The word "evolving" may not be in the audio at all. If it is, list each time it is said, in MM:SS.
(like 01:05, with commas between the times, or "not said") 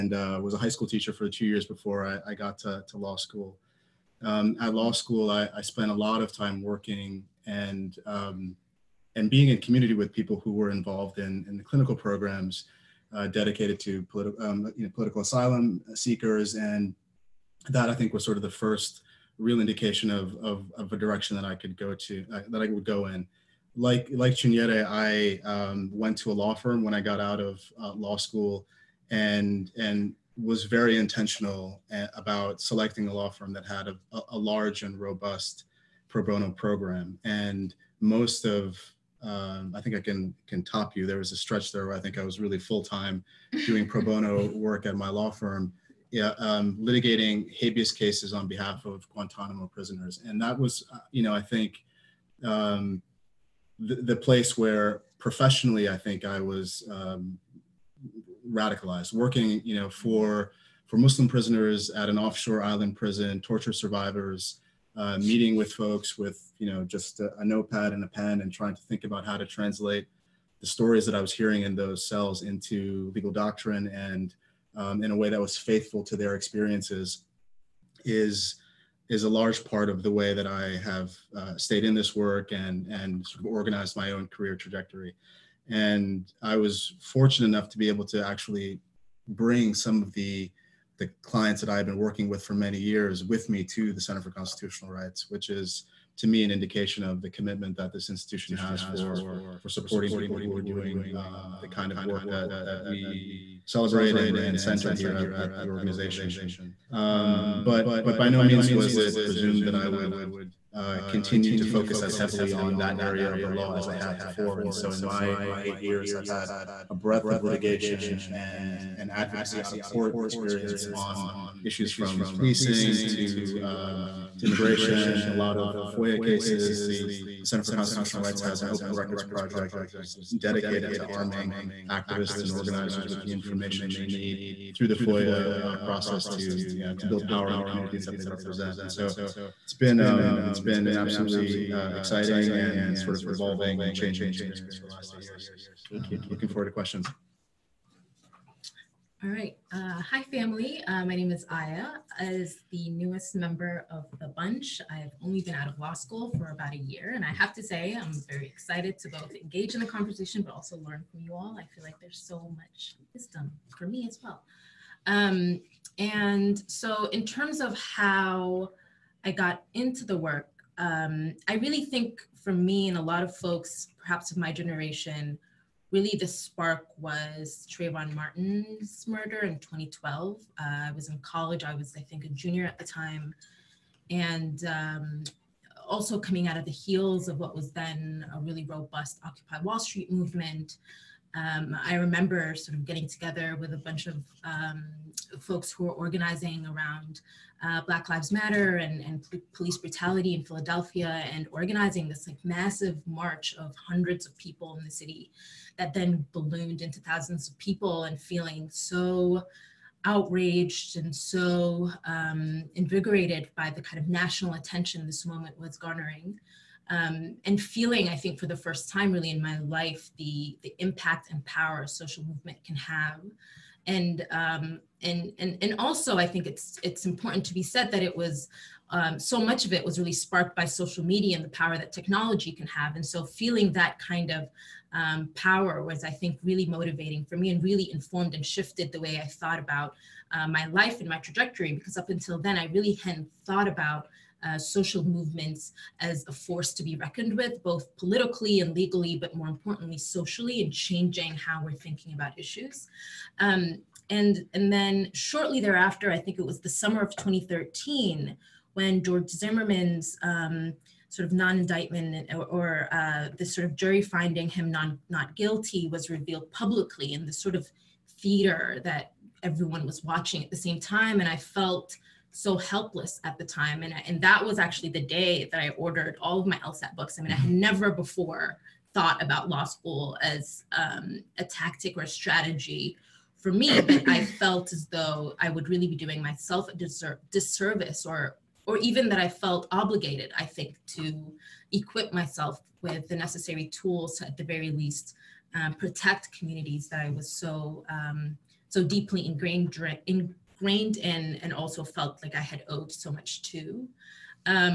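02:23.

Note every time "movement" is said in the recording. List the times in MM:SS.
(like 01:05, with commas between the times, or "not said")
03:10, 03:42, 04:05.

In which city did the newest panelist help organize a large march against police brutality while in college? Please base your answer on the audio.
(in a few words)
Philadelphia.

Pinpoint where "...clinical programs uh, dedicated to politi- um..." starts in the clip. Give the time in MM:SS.
00:11.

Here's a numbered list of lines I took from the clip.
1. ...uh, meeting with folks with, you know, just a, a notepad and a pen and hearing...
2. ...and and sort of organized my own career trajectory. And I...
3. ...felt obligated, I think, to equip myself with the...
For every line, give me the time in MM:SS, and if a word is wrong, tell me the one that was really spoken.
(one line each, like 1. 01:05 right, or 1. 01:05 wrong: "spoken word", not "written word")
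1. 01:04 wrong: "trying", not "hearing"
2. 01:22 right
3. 04:49 right.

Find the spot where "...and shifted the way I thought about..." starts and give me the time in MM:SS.
03:58.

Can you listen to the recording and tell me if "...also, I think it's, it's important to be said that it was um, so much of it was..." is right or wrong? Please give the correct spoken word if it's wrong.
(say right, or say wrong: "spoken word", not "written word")
right.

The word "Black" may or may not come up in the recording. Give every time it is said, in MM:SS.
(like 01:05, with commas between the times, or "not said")
03:17.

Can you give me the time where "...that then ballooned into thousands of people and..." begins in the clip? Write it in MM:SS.
03:25.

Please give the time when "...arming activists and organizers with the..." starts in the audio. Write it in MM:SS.
02:11.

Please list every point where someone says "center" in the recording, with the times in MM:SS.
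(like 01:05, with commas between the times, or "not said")
01:33, 01:44, 02:07.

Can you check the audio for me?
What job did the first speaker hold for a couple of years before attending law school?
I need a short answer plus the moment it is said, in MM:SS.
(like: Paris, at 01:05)
High school teacher, at 00:00.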